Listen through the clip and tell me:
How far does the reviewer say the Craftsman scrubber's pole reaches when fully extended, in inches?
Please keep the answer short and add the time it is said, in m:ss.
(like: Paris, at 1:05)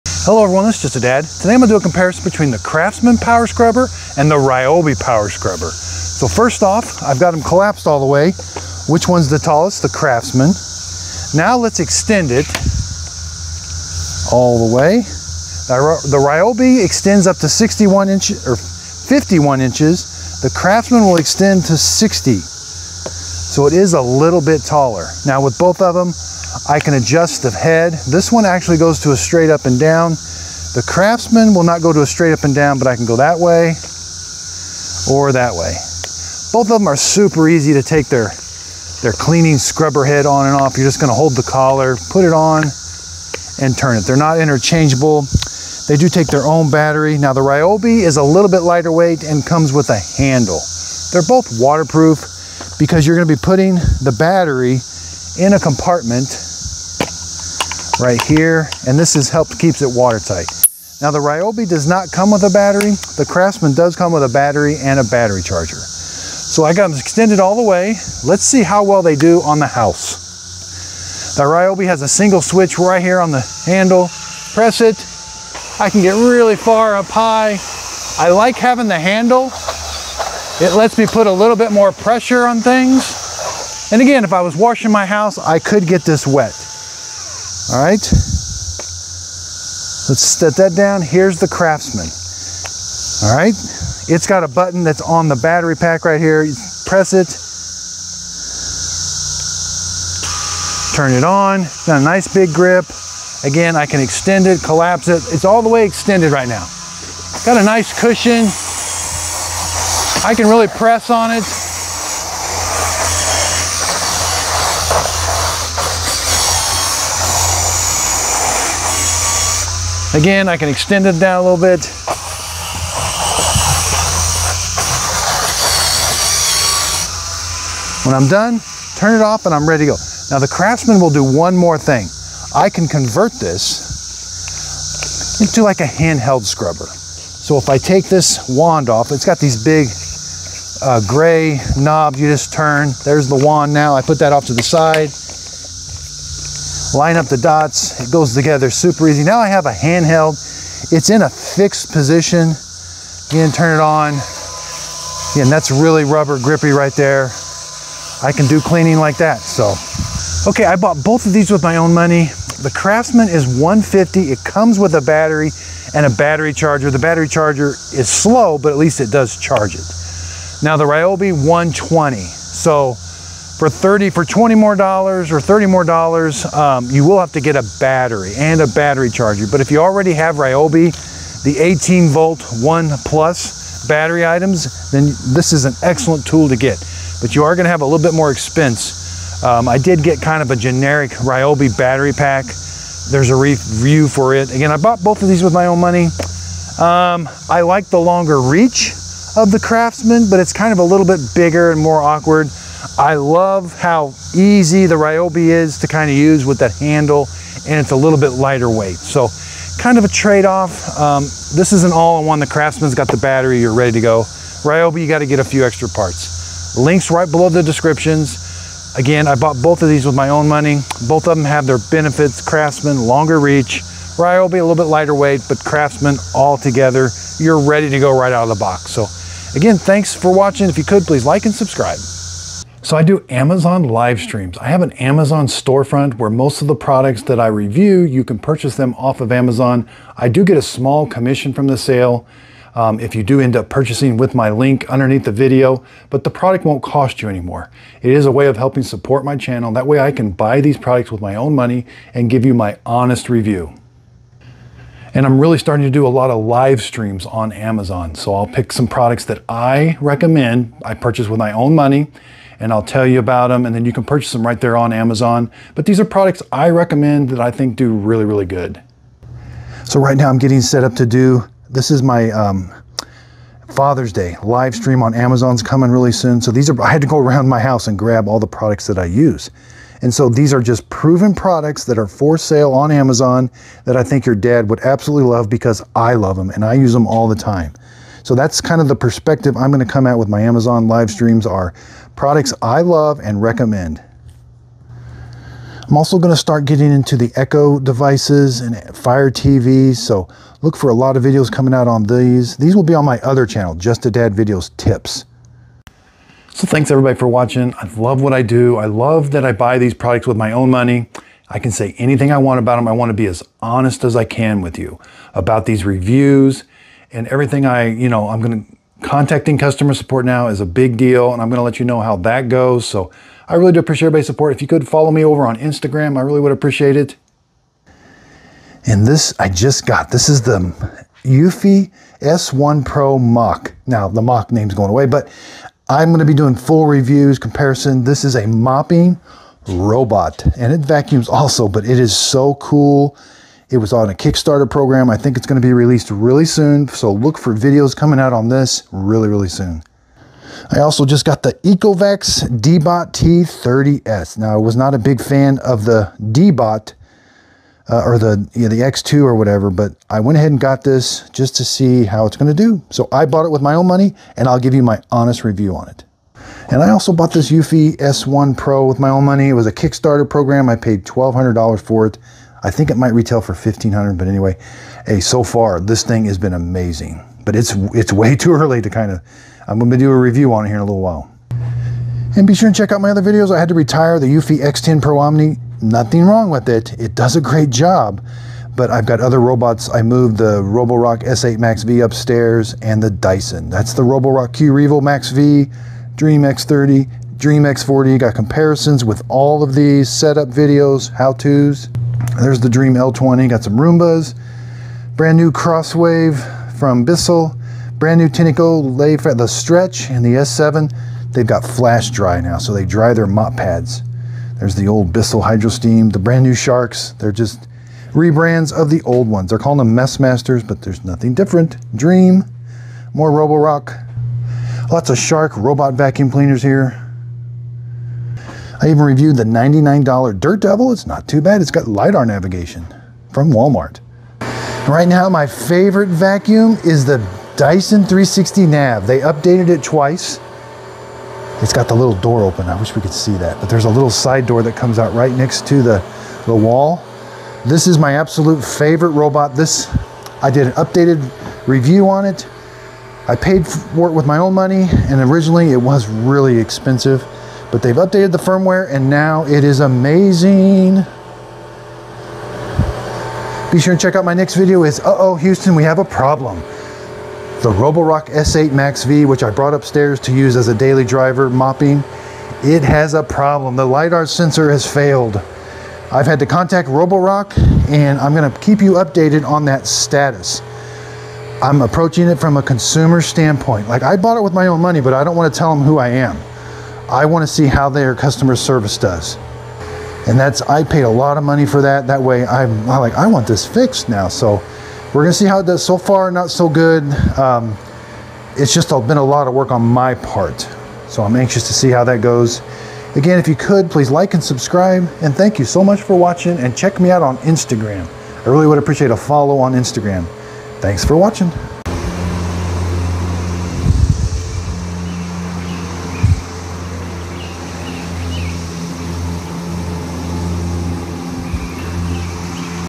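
60, at 0:21.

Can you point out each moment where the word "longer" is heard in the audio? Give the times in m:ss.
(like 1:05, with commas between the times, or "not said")
3:18, 3:42.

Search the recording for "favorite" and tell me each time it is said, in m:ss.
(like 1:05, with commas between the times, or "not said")
7:15, 7:28.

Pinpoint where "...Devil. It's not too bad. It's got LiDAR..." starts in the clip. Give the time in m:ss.
7:10.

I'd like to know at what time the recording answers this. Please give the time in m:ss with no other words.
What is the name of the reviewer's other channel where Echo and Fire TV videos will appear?
5:03.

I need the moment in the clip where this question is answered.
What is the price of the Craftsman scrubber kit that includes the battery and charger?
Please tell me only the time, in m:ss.
2:43.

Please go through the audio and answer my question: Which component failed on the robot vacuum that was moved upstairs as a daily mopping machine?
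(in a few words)
LiDAR sensor.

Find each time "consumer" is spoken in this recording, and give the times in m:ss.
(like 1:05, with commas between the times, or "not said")
8:02.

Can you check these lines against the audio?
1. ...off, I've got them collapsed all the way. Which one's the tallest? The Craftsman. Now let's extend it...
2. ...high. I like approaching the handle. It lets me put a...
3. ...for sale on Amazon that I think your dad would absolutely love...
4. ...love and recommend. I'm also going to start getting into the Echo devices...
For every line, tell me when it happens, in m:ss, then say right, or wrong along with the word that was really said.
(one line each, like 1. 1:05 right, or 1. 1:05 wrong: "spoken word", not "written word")
1. 0:06 right
2. 1:17 wrong: "having", not "approaching"
3. 4:42 right
4. 4:52 right.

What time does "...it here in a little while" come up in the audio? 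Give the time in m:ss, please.
6:20.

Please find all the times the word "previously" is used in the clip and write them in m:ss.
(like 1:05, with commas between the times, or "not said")
not said.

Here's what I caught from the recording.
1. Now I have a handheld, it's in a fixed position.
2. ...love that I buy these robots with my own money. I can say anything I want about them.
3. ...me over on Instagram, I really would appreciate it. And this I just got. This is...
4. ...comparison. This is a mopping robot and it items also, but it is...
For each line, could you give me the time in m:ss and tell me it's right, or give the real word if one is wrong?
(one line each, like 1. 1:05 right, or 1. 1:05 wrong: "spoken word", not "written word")
1. 2:29 right
2. 5:08 wrong: "products", not "robots"
3. 5:25 right
4. 5:37 wrong: "vacuums", not "items".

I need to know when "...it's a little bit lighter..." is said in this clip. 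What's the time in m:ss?
3:27.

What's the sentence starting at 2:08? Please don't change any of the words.
When I'm done, turn it off and I'm ready to go.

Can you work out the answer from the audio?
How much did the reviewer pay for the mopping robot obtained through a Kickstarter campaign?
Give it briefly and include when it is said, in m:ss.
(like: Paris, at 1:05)
$1,200, at 6:11.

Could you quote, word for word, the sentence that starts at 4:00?
I do get a small commission from the sale.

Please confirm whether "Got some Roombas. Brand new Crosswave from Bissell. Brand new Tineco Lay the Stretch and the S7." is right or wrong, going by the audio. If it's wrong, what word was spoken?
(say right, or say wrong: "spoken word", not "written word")
right.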